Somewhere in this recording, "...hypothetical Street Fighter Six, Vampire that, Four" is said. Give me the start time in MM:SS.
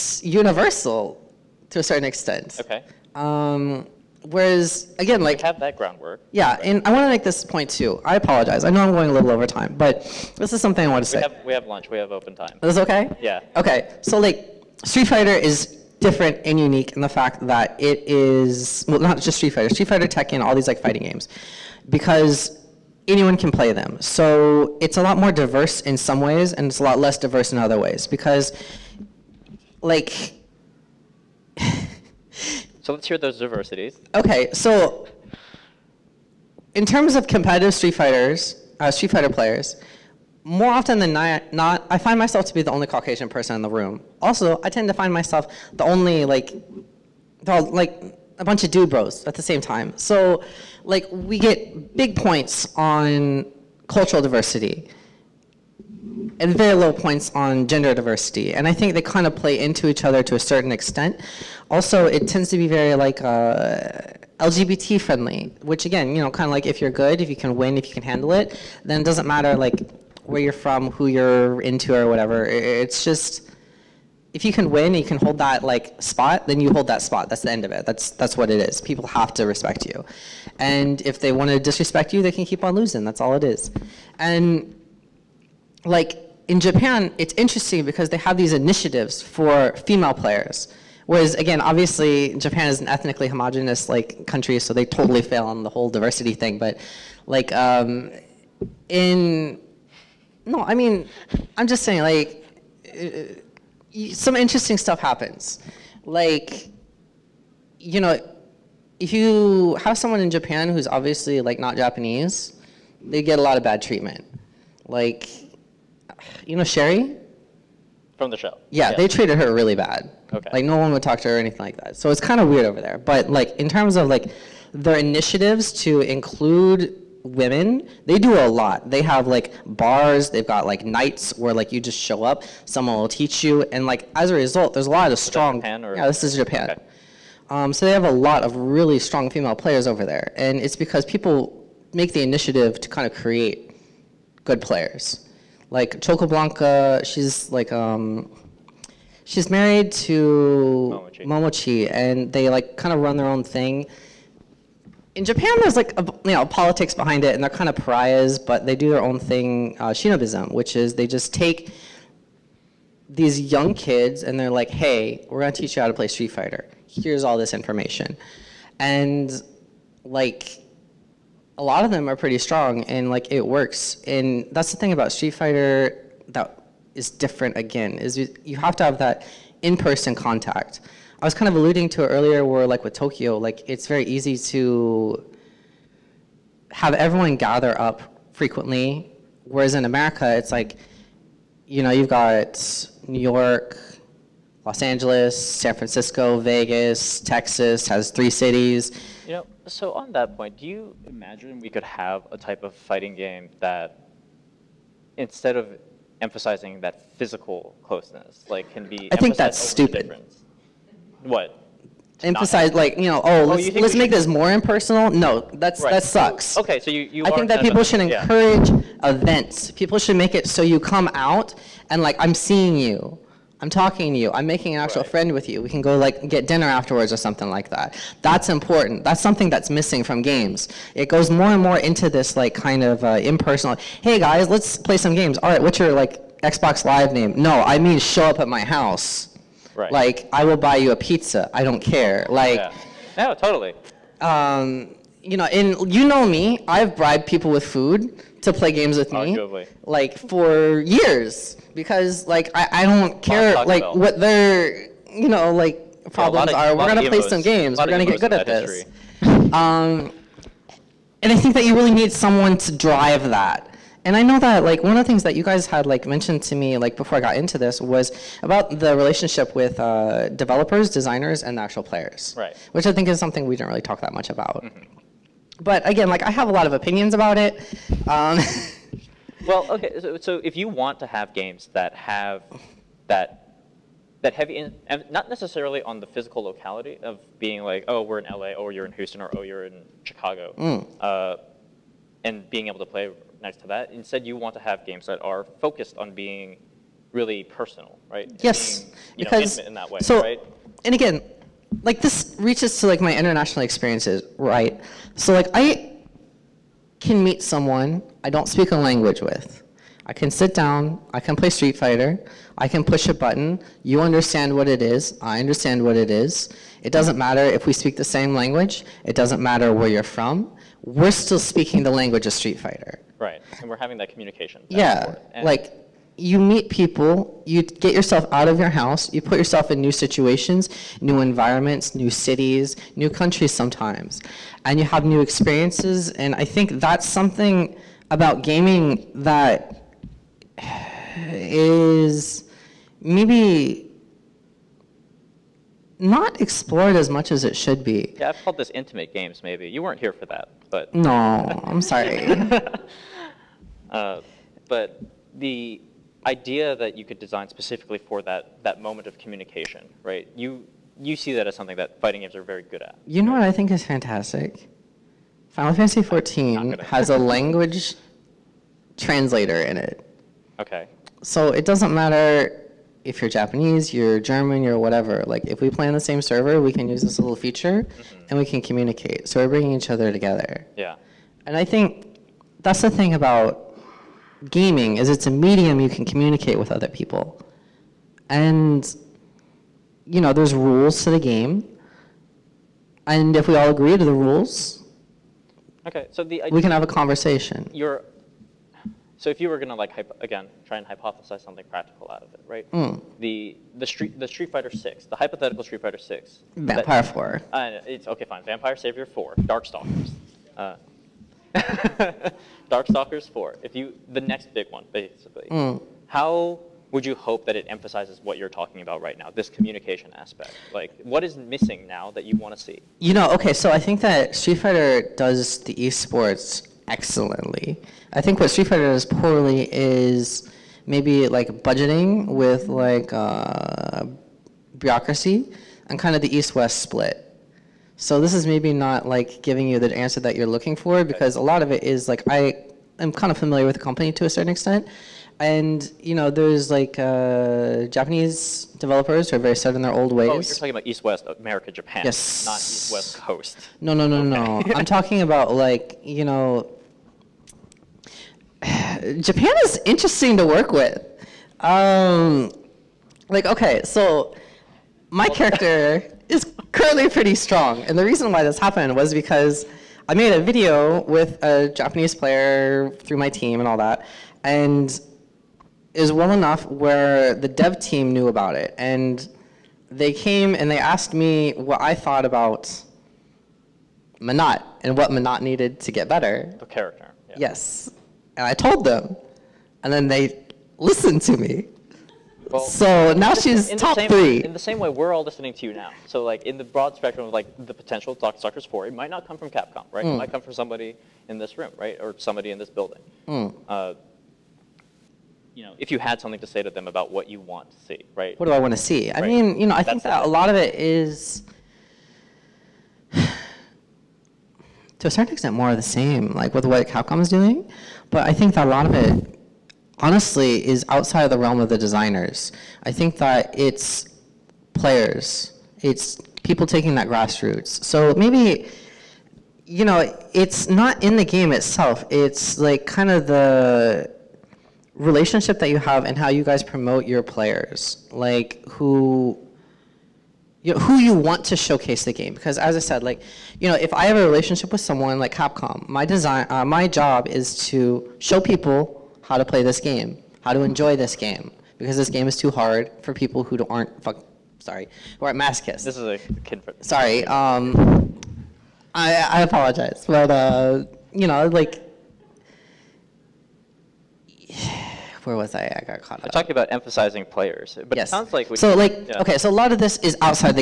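06:45.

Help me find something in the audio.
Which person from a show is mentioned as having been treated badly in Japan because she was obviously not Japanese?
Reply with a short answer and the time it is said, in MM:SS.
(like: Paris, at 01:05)
Sherry, at 01:56.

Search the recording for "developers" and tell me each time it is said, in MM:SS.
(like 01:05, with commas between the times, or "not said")
04:30, 07:28.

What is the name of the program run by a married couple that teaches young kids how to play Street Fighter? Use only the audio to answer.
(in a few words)
Shinobism.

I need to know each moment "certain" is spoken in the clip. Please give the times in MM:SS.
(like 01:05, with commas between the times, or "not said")
00:01, 01:00, 07:24, 08:35.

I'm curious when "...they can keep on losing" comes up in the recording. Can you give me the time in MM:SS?
01:22.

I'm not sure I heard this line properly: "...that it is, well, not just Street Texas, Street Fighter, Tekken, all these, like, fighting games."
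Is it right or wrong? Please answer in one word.
wrong.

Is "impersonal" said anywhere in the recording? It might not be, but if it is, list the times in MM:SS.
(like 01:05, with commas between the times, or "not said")
03:34, 03:53.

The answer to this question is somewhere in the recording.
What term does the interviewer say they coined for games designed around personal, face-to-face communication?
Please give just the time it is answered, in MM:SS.
05:48.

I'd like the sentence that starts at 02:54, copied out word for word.
And that's the thing about Street Fighter that is different again is you, you have to have that in-person contact.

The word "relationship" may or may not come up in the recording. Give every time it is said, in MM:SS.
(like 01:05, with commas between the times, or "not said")
04:28, 08:54, 09:04.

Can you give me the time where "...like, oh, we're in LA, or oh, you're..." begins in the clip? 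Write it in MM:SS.
04:47.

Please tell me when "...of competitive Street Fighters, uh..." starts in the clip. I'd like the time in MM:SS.
00:37.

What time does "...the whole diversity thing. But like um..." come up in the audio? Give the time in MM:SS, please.
01:35.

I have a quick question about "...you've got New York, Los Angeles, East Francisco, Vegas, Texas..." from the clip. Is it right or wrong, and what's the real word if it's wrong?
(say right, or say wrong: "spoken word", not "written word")
wrong: "San", not "East".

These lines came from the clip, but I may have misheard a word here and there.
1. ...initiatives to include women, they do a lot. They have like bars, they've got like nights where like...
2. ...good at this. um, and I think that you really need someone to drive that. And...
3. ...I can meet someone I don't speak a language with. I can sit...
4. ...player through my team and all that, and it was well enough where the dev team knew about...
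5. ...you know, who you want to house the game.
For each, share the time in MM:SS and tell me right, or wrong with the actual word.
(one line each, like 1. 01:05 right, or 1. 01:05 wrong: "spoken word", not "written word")
1. 02:04 right
2. 04:18 right
3. 05:05 right
4. 07:52 right
5. 09:00 wrong: "showcase", not "house".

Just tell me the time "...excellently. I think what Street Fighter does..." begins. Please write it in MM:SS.
07:06.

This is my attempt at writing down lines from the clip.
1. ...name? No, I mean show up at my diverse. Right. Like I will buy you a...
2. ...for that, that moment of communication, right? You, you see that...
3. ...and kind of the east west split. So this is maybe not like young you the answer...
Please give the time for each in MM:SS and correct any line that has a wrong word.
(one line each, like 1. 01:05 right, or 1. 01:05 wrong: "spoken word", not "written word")
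1. 03:57 wrong: "house", not "diverse"
2. 05:57 right
3. 07:15 wrong: "giving", not "young".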